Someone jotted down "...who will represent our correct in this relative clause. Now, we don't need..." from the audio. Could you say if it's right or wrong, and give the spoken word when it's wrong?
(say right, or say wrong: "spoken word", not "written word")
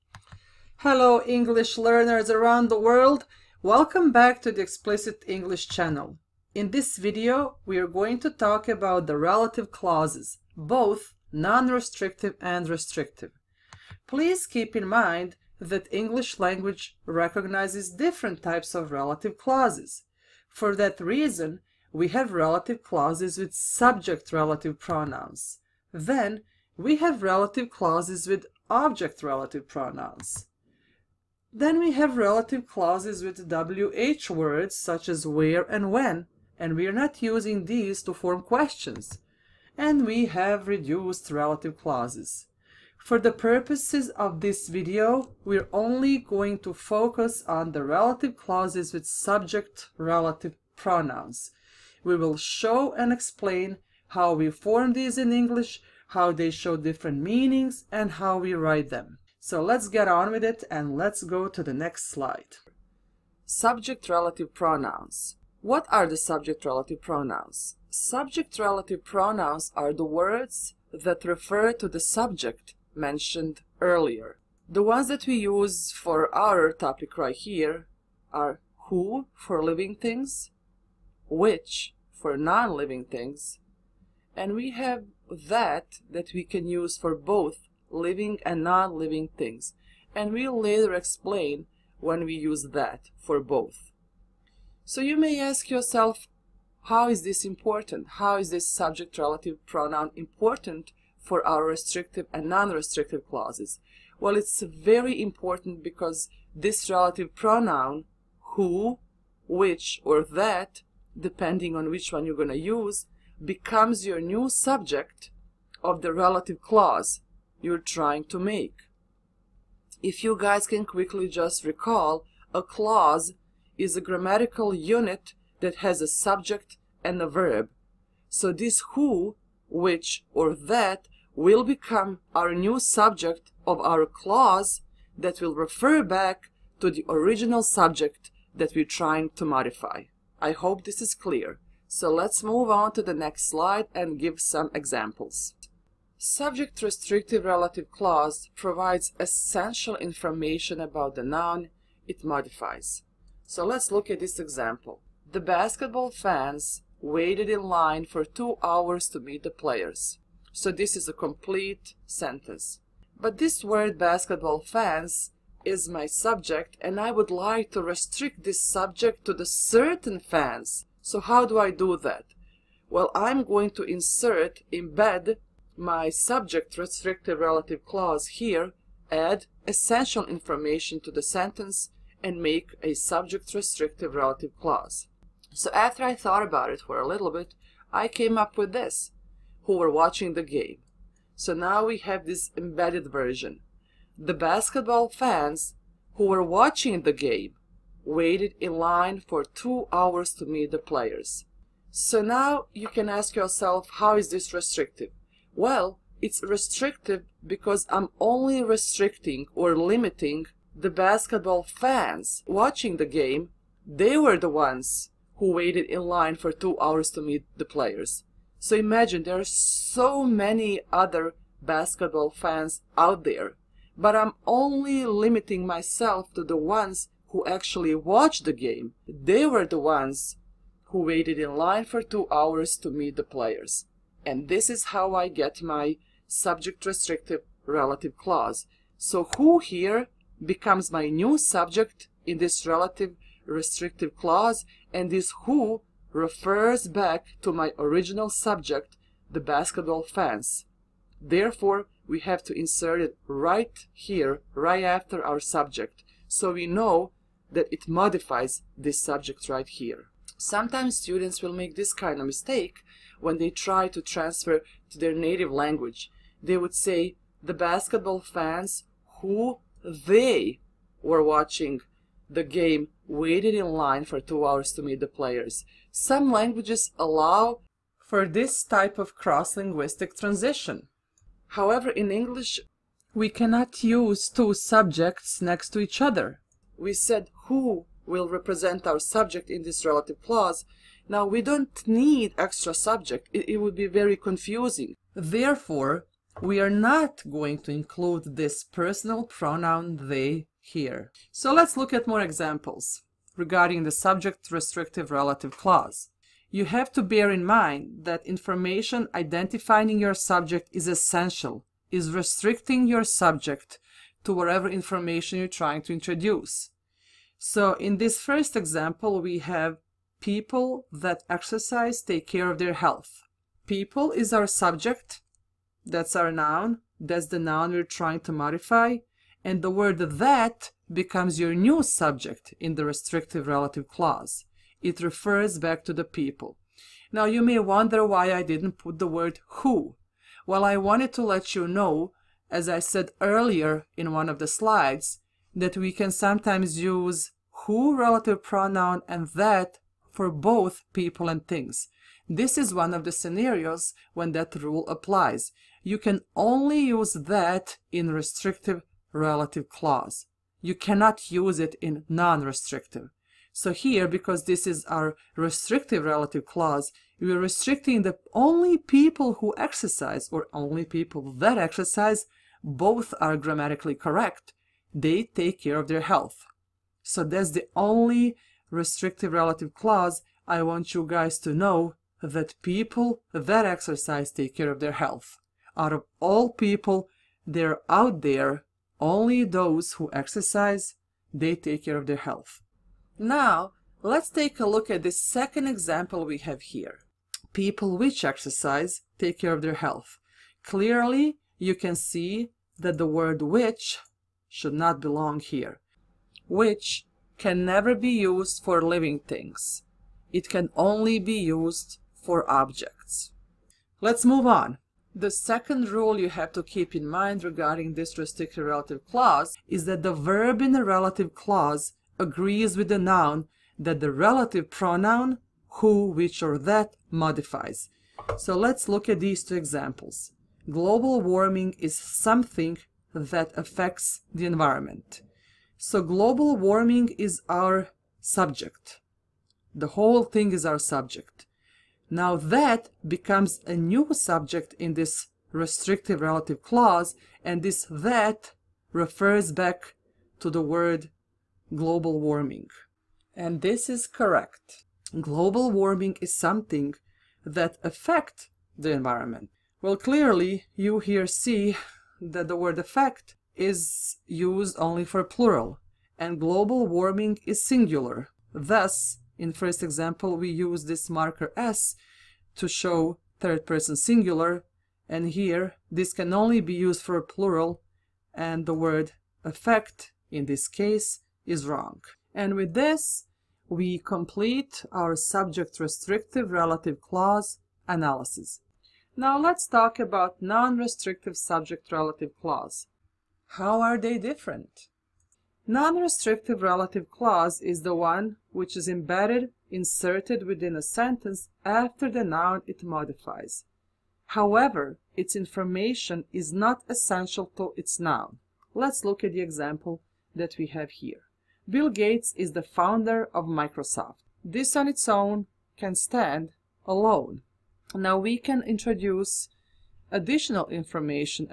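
wrong: "subject", not "correct".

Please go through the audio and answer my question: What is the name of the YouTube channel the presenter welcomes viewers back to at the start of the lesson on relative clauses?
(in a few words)
Explicit English.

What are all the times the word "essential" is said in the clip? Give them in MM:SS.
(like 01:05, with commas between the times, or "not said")
02:29, 02:59, 05:10, 08:26.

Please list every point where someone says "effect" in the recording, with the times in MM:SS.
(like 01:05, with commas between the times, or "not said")
07:42, 07:59.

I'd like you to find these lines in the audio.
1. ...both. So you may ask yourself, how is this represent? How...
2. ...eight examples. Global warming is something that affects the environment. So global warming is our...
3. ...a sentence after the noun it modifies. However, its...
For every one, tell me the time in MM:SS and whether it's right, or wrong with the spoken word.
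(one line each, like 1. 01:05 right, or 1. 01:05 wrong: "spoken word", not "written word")
1. 01:33 wrong: "important", not "represent"
2. 07:09 wrong: "two", not "eight"
3. 08:20 right.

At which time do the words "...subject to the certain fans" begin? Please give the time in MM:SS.
02:48.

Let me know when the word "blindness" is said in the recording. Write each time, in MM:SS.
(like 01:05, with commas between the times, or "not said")
not said.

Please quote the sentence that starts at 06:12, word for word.
Both are grammatically correct they take care of their health.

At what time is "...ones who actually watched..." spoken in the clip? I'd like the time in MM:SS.
03:46.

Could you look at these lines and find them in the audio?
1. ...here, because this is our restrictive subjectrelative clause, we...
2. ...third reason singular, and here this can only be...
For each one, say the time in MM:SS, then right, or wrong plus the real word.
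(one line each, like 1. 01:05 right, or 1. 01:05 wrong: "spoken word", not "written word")
1. 06:03 wrong: "relative", not "subjectrelative"
2. 07:53 wrong: "person", not "reason".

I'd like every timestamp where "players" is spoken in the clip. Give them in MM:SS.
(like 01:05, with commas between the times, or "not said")
02:39, 03:20, 03:37, 03:53, 04:35.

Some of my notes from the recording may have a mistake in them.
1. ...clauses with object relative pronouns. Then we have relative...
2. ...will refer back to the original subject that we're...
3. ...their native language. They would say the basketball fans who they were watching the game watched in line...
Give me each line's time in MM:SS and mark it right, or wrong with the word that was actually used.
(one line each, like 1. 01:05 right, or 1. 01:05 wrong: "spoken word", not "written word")
1. 00:27 right
2. 02:15 right
3. 04:24 wrong: "waited", not "watched".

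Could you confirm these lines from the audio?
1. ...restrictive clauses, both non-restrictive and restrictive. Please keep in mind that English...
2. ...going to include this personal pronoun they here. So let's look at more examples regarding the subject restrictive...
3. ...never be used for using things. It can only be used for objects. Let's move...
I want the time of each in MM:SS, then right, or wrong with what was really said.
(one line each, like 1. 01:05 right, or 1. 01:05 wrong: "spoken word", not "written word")
1. 00:09 wrong: "relative", not "restrictive"
2. 04:57 right
3. 06:47 wrong: "living", not "using".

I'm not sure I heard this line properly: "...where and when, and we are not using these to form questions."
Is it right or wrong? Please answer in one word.
right.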